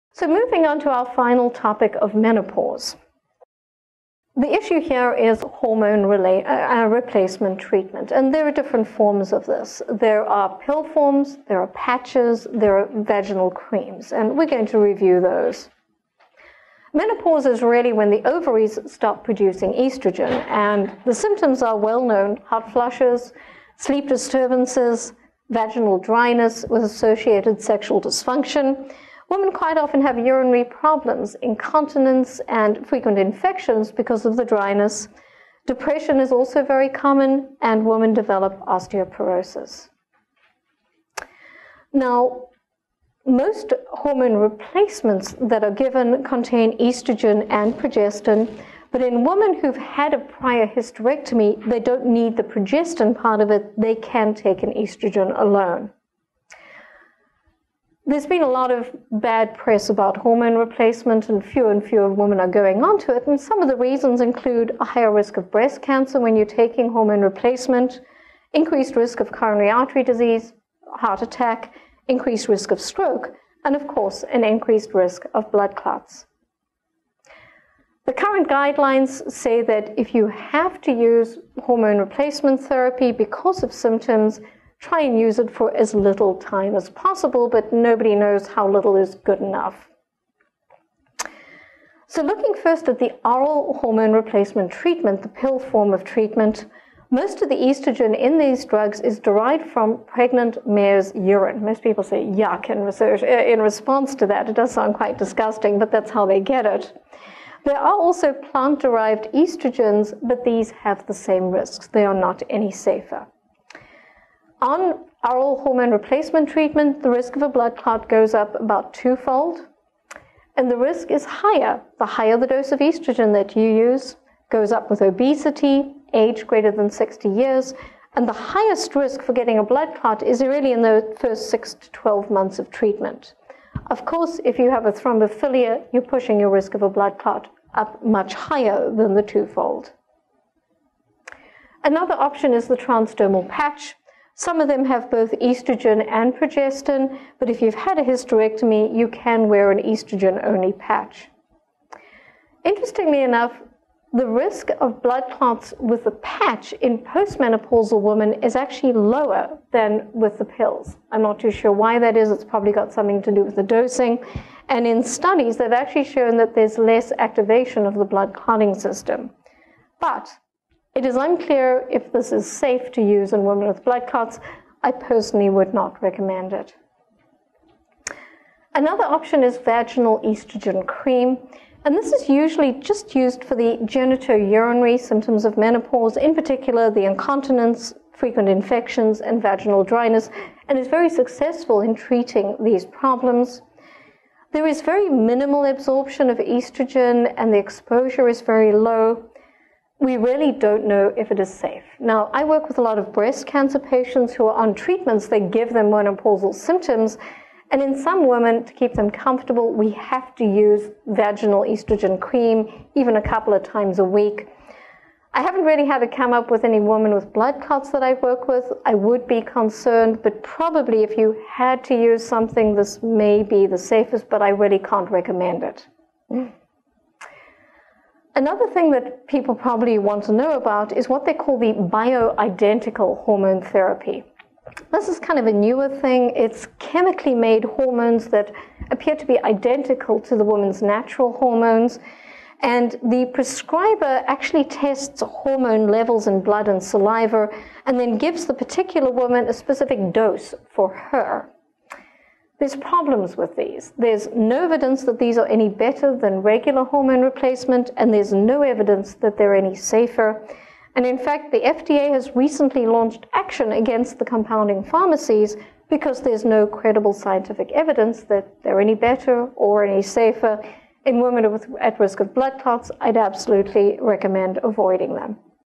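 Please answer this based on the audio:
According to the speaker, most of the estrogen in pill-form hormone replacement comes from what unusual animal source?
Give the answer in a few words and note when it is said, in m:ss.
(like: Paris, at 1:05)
pregnant mare's urine, at 1:40.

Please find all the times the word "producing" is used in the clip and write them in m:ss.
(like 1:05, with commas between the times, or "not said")
0:19.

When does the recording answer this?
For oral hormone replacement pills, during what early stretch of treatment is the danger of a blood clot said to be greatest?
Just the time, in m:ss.
2:11.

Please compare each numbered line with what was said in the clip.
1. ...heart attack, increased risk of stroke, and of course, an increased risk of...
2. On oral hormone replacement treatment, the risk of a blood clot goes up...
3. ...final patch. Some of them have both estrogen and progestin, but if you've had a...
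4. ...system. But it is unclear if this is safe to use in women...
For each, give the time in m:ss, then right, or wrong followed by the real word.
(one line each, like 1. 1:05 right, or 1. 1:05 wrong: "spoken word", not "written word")
1. 1:10 right
2. 1:54 right
3. 2:22 wrong: "transdermal", not "final"
4. 2:48 right.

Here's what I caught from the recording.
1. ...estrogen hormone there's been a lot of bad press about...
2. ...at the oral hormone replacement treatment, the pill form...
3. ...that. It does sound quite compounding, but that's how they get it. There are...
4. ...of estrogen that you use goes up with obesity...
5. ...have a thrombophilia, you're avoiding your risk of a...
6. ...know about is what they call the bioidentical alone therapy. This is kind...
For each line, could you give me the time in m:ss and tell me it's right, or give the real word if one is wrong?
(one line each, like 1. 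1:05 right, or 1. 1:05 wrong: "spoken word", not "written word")
1. 0:54 wrong: "alone", not "hormone"
2. 1:32 right
3. 1:44 wrong: "disgusting", not "compounding"
4. 2:02 right
5. 2:14 wrong: "pushing", not "avoiding"
6. 3:50 wrong: "hormone", not "alone".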